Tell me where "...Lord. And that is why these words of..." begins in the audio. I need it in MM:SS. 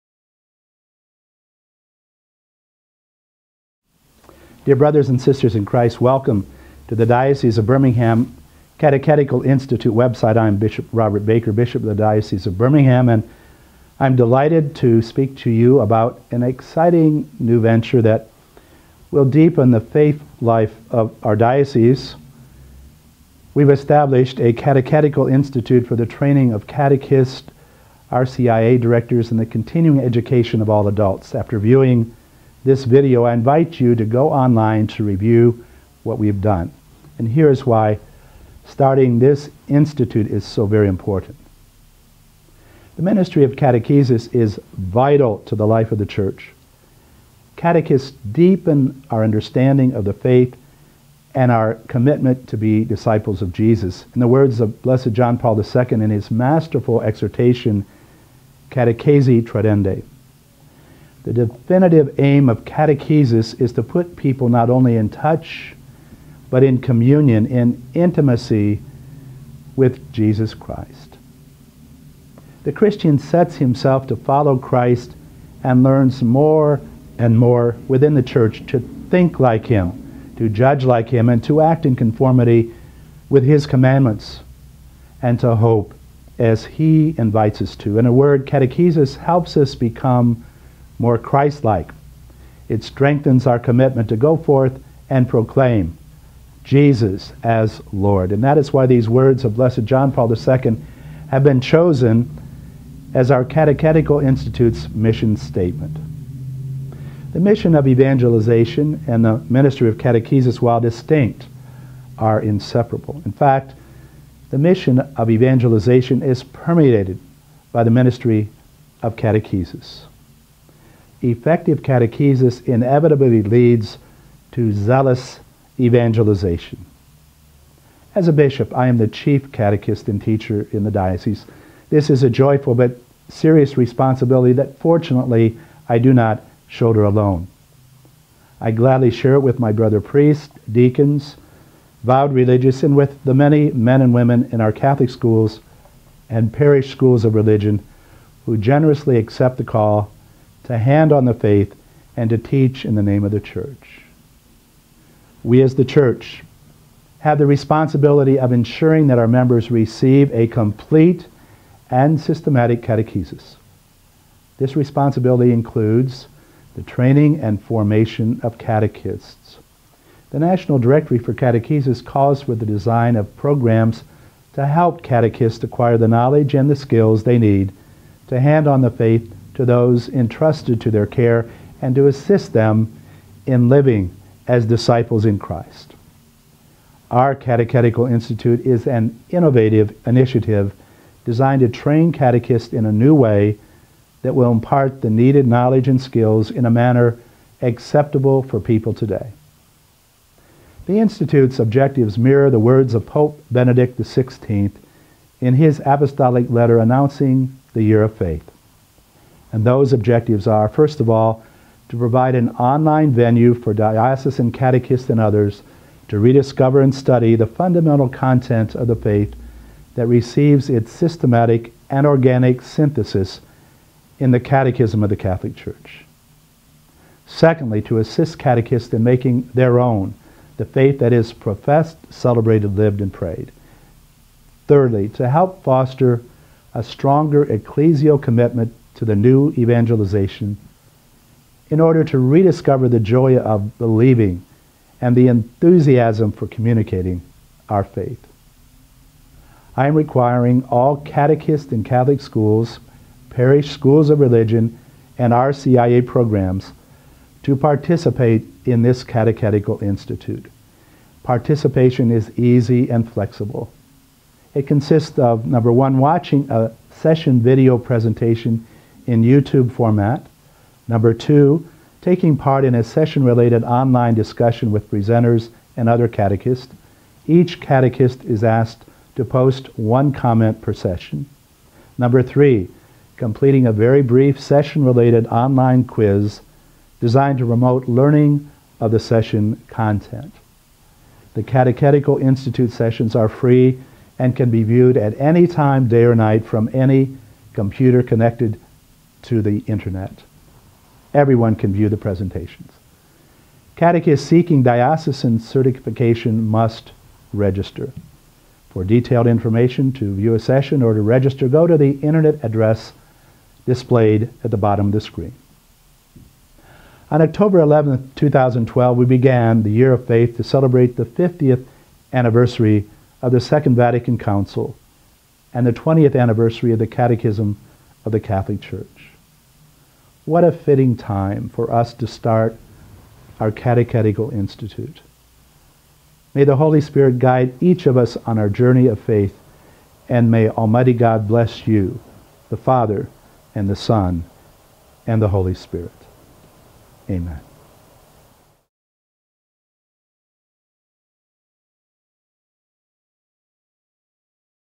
01:37.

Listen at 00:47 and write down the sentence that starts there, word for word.
Catechists deepen our understanding of the faith and our commitment to be disciples of Jesus.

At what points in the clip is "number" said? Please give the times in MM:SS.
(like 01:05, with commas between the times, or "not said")
04:25, 04:30, 04:41.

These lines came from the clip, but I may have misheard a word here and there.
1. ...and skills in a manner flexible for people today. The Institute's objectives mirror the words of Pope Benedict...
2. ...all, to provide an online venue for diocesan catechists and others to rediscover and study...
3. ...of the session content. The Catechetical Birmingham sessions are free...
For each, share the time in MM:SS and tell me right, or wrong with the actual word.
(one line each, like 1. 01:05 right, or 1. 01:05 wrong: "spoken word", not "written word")
1. 03:15 wrong: "acceptable", not "flexible"
2. 03:31 right
3. 04:48 wrong: "Institute", not "Birmingham".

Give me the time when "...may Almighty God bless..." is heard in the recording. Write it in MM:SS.
05:40.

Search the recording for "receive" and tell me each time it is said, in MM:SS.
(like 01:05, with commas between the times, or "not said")
02:39, 03:40.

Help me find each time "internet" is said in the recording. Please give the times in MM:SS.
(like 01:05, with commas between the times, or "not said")
04:59, 05:11.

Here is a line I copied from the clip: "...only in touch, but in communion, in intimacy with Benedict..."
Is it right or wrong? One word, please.
wrong.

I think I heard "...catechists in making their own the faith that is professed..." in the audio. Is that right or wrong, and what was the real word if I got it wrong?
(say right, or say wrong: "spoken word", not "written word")
right.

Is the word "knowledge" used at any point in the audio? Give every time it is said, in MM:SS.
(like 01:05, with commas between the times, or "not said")
02:56, 03:15.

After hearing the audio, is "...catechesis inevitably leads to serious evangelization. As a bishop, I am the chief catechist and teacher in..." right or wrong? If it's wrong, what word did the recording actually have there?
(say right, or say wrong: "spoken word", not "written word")
wrong: "zealous", not "serious".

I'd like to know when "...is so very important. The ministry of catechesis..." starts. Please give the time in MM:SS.
00:40.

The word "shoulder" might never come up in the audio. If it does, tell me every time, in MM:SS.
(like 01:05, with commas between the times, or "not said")
02:16.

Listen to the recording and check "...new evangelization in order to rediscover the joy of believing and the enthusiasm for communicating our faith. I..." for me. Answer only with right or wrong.
right.